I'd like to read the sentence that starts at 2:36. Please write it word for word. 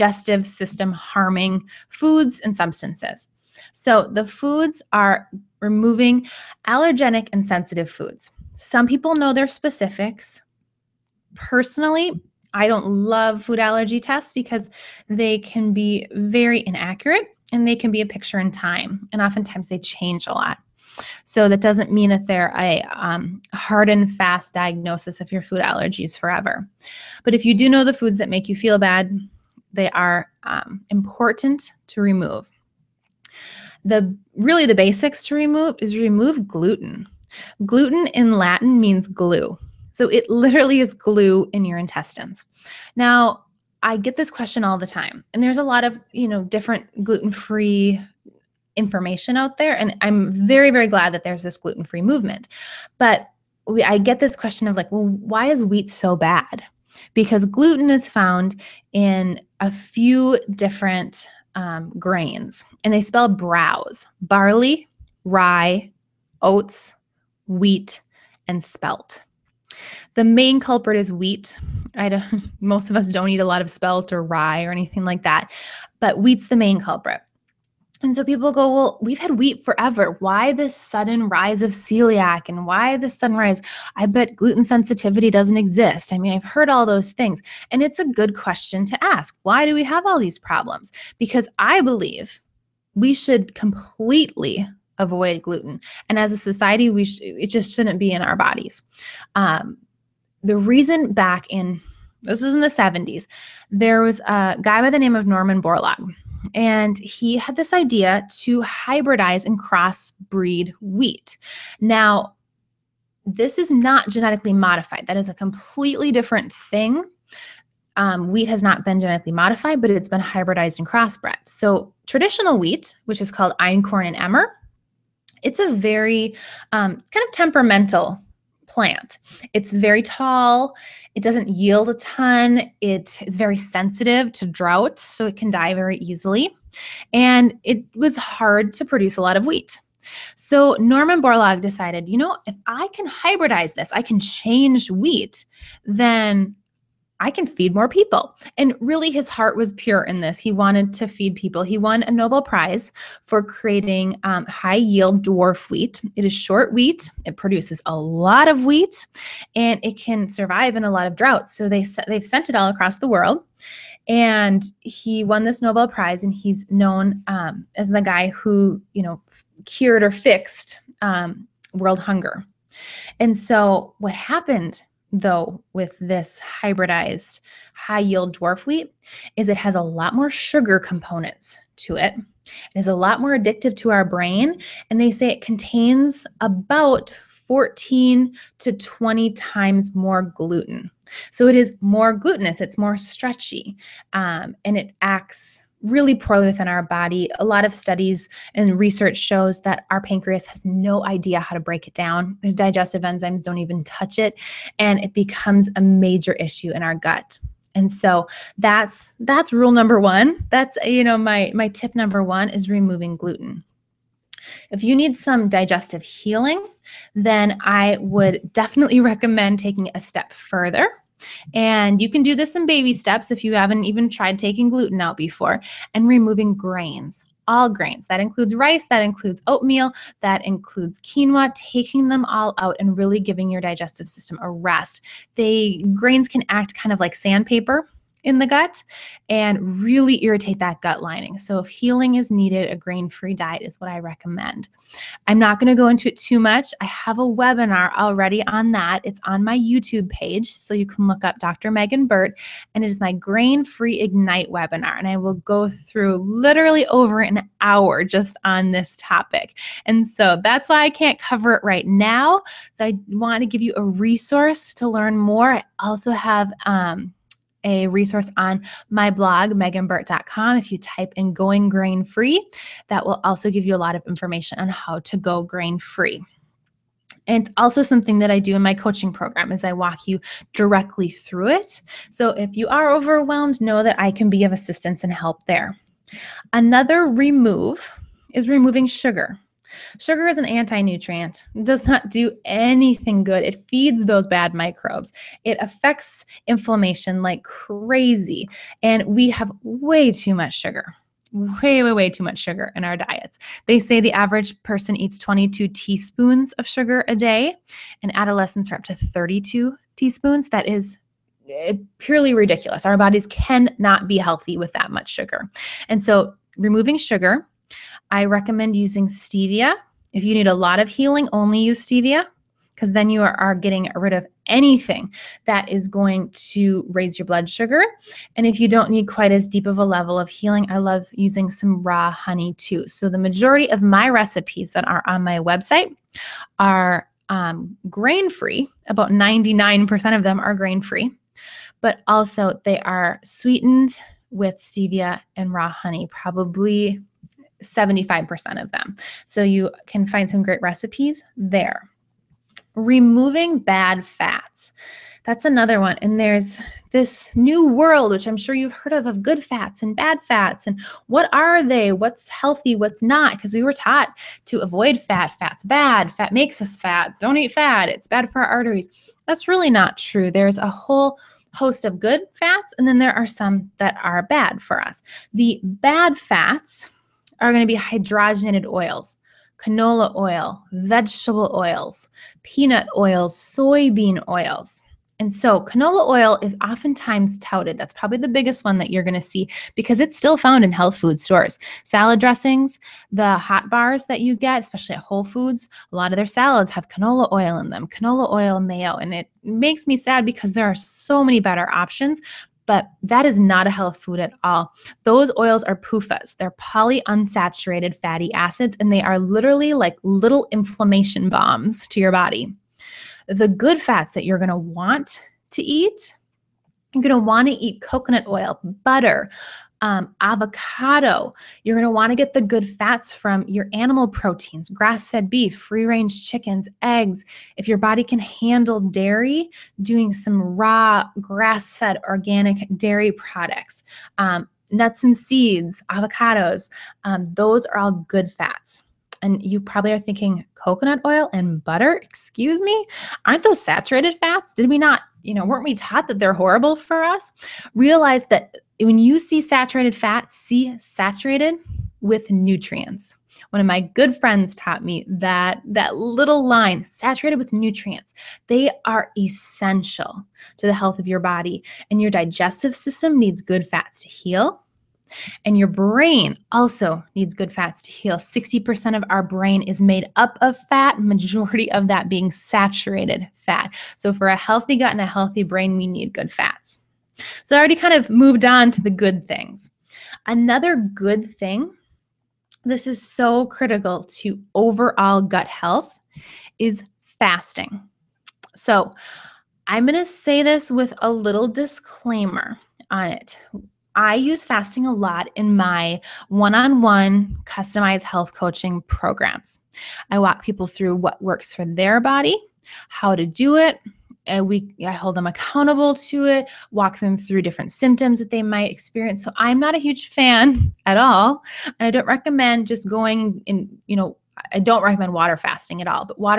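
It is short wheat, it produces a lot of wheat, and it can survive in a lot of droughts.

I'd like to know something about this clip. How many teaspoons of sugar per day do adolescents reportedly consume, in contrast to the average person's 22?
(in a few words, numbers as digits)
32.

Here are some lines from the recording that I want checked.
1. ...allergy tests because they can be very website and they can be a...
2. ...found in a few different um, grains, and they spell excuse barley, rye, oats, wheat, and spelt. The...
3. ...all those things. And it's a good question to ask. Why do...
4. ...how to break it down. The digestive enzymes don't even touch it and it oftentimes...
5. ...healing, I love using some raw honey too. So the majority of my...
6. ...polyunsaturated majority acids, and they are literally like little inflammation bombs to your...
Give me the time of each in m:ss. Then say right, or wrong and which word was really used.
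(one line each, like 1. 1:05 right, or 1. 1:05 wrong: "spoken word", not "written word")
1. 0:13 wrong: "inaccurate", not "website"
2. 0:58 wrong: "browse", not "excuse"
3. 1:26 right
4. 3:21 wrong: "becomes", not "oftentimes"
5. 5:30 right
6. 6:46 wrong: "fatty", not "majority".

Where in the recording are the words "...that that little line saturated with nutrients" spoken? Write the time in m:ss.
7:35.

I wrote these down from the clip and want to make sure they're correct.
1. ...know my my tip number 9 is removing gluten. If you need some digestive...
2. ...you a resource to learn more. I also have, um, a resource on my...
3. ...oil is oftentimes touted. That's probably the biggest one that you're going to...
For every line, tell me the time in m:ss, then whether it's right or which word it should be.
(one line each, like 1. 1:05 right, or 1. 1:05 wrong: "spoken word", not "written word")
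1. 3:31 wrong: "1", not "9"
2. 4:23 right
3. 6:26 right.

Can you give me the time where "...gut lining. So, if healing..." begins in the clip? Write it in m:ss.
4:00.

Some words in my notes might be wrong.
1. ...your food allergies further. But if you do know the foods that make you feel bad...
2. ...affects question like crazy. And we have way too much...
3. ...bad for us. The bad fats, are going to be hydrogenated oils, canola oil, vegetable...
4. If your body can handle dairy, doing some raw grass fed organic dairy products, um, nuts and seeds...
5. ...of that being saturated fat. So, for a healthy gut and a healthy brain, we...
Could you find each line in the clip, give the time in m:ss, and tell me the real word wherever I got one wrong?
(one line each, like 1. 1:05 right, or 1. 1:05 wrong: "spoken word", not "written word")
1. 0:25 wrong: "forever", not "further"
2. 4:55 wrong: "inflammation", not "question"
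3. 6:14 right
4. 7:07 right
5. 7:51 right.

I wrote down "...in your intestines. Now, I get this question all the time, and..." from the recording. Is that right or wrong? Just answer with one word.
right.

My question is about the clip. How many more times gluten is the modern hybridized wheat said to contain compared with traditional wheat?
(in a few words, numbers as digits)
14 to 20 times.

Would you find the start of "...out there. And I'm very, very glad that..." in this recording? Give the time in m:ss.
0:49.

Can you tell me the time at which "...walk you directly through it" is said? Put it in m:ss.
4:39.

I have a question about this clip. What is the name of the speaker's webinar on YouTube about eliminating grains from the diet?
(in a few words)
grain free Ignite.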